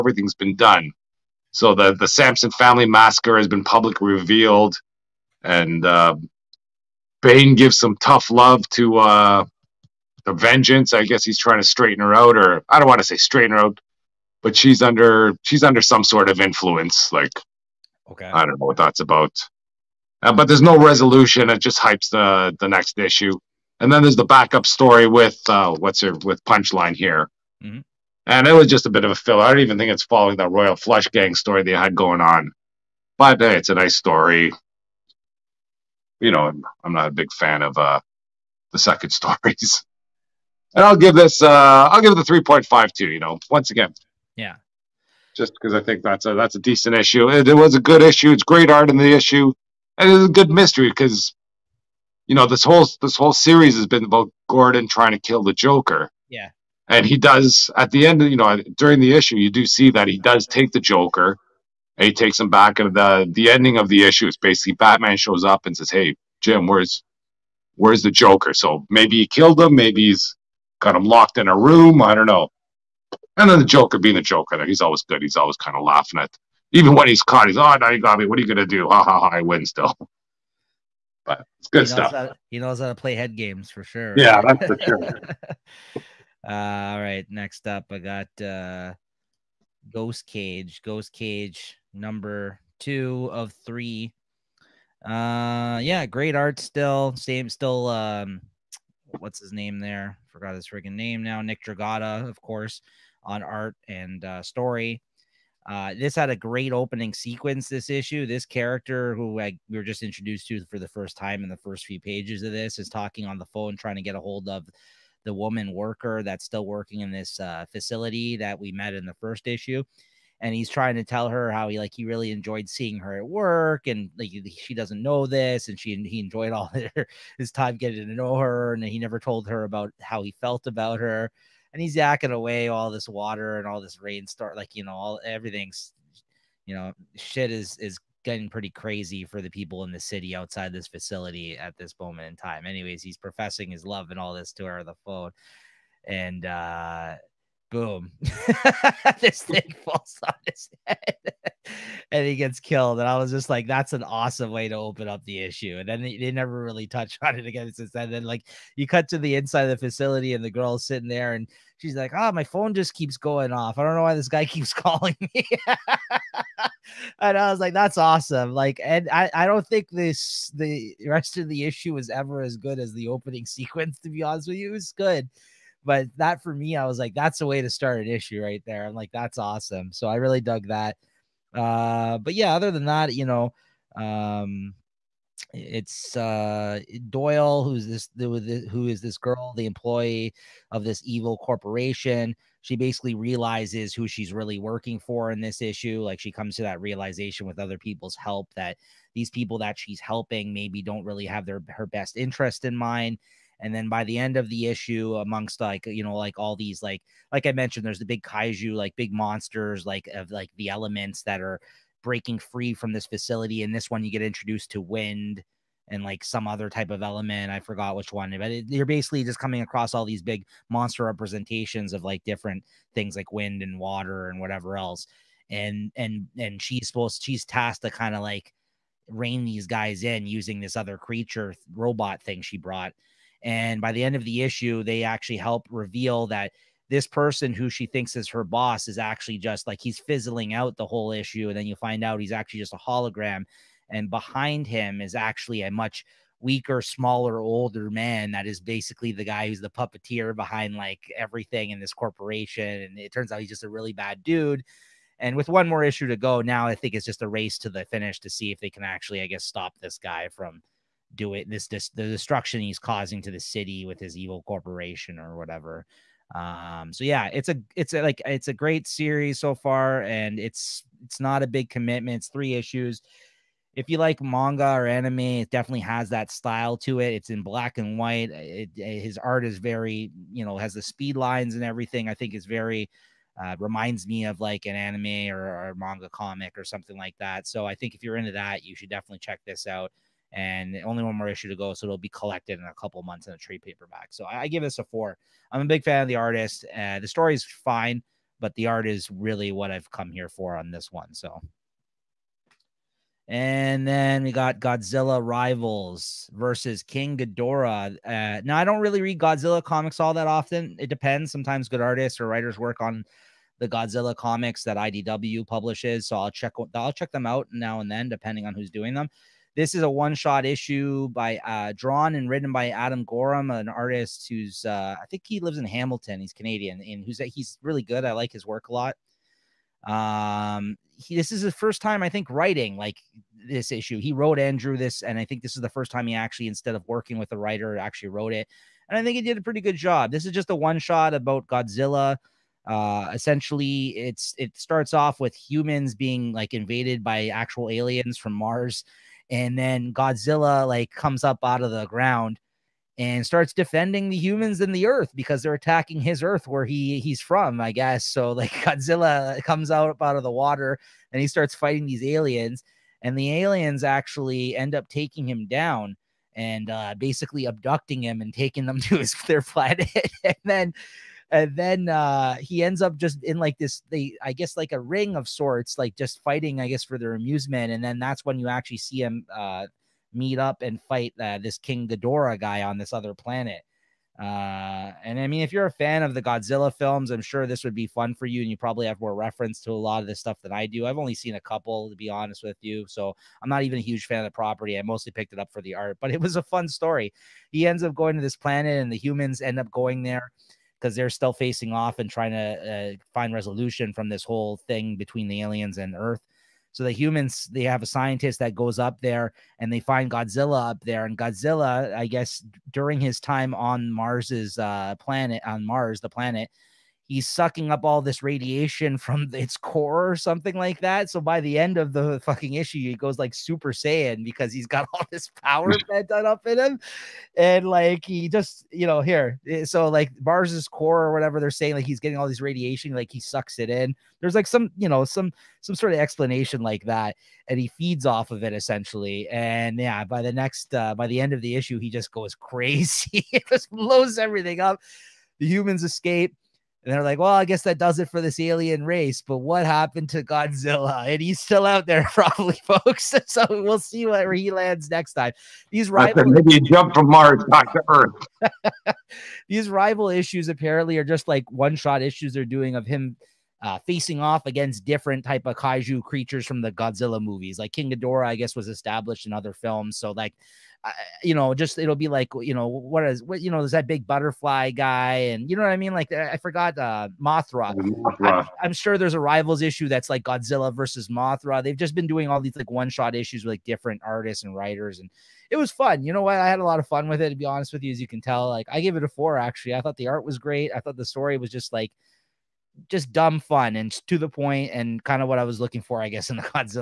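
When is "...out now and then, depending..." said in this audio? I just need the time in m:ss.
5:17.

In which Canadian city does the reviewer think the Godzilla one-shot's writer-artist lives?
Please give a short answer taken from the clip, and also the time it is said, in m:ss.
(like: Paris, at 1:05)
Hamilton, at 5:25.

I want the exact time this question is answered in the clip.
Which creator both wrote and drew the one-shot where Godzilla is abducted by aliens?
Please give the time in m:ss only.
5:22.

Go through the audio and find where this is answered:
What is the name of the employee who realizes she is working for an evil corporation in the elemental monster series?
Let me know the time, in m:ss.
3:07.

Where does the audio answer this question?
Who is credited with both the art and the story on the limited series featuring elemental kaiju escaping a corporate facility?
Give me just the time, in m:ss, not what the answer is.
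1:41.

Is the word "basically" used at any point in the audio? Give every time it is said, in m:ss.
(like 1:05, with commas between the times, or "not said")
1:04, 3:12, 3:38, 4:08, 6:06.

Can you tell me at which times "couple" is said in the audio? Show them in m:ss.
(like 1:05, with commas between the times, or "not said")
4:52, 6:31.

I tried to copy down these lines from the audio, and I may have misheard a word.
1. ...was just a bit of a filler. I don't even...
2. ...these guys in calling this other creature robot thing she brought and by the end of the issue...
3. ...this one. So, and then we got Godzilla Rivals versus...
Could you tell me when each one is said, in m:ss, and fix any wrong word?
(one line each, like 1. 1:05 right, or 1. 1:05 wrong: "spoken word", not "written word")
1. 0:28 right
2. 3:49 wrong: "using", not "calling"
3. 5:00 right.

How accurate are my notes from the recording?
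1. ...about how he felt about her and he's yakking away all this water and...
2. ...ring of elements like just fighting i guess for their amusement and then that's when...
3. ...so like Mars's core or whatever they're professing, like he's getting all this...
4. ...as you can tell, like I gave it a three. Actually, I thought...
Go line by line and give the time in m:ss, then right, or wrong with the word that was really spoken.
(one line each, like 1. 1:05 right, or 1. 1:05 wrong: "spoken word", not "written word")
1. 2:09 right
2. 6:14 wrong: "sorts", not "elements"
3. 7:09 wrong: "saying", not "professing"
4. 8:07 wrong: "four", not "three".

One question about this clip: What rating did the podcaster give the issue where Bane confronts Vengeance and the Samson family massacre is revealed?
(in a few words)
3.5.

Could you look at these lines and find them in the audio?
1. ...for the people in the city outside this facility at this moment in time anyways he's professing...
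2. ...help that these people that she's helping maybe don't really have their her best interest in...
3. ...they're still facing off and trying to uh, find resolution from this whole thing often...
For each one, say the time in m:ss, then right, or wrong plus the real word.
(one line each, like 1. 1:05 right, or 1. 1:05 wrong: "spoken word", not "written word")
1. 2:19 right
2. 3:18 right
3. 6:40 wrong: "between", not "often".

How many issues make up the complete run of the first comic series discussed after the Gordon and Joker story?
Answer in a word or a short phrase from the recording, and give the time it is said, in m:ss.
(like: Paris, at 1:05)
3, at 1:30.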